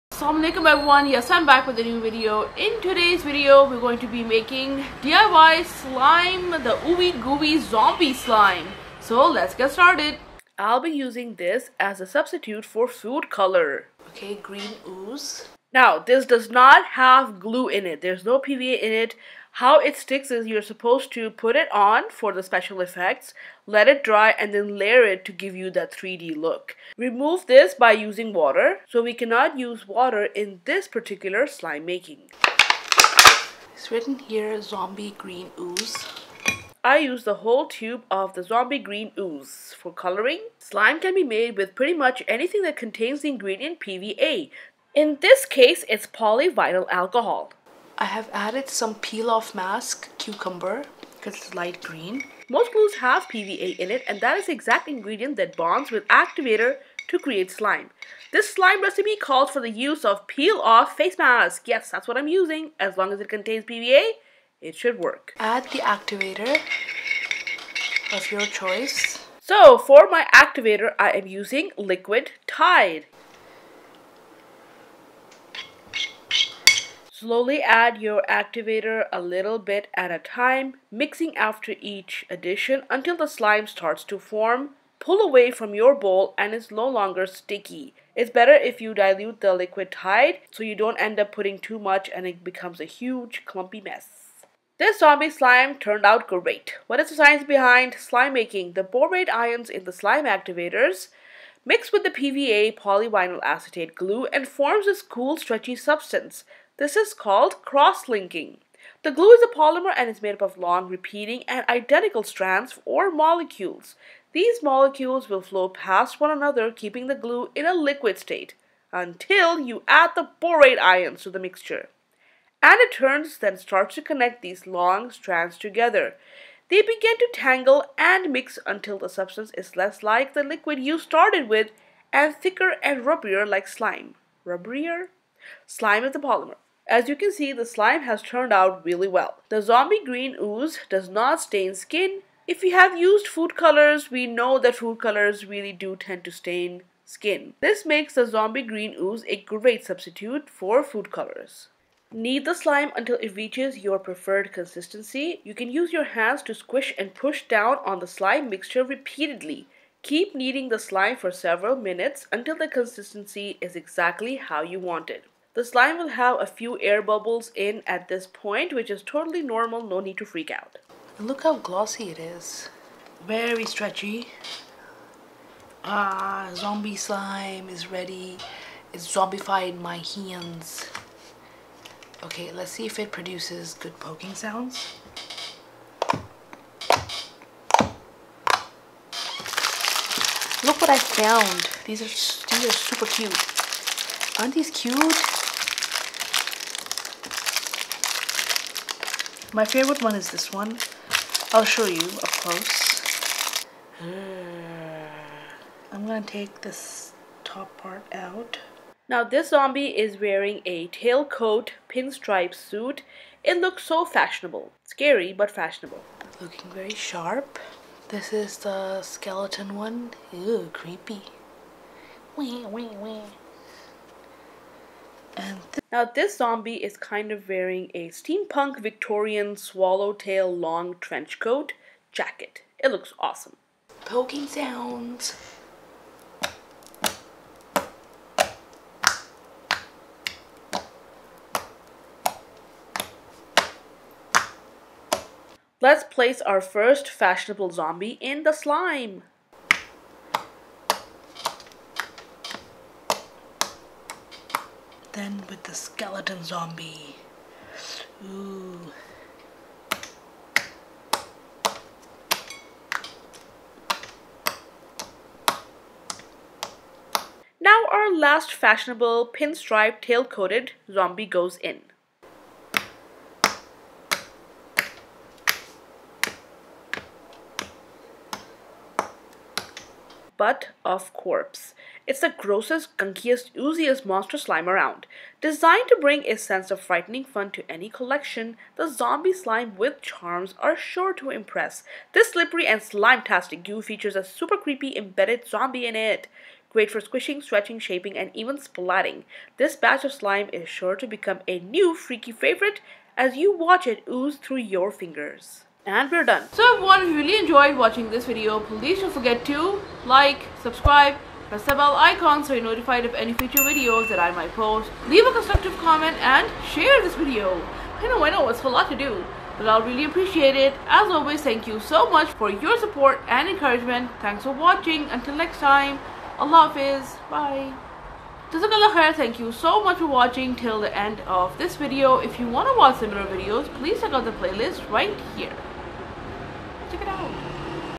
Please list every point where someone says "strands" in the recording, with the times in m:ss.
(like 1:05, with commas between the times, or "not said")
1:52, 2:05.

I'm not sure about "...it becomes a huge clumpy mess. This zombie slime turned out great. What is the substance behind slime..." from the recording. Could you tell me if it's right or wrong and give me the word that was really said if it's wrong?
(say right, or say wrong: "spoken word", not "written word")
wrong: "science", not "substance".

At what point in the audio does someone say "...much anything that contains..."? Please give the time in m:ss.
0:41.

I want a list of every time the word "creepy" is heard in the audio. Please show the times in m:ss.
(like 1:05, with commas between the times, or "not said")
3:40, 4:54.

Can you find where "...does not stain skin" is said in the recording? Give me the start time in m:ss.
2:20.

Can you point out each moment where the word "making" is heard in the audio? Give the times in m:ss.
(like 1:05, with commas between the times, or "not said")
0:04, 0:31, 1:38.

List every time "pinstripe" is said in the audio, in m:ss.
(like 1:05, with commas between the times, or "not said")
3:31, 4:29.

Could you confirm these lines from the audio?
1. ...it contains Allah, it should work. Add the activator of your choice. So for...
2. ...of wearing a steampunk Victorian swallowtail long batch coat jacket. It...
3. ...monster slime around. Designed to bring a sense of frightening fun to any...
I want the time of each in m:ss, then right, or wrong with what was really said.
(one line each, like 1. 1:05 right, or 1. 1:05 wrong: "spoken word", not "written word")
1. 1:03 wrong: "PVA", not "Allah"
2. 3:47 wrong: "trench", not "batch"
3. 4:44 right.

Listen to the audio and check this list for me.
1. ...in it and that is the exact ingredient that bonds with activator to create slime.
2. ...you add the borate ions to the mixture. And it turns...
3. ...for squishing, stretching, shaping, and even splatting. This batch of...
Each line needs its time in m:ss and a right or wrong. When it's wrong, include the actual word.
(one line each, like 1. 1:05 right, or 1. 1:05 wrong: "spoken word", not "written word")
1. 0:53 right
2. 1:59 right
3. 4:56 right.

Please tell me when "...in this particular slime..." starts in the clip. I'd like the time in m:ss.
0:30.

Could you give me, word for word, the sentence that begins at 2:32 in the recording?
Knead the slime until it reaches your preferred consistency.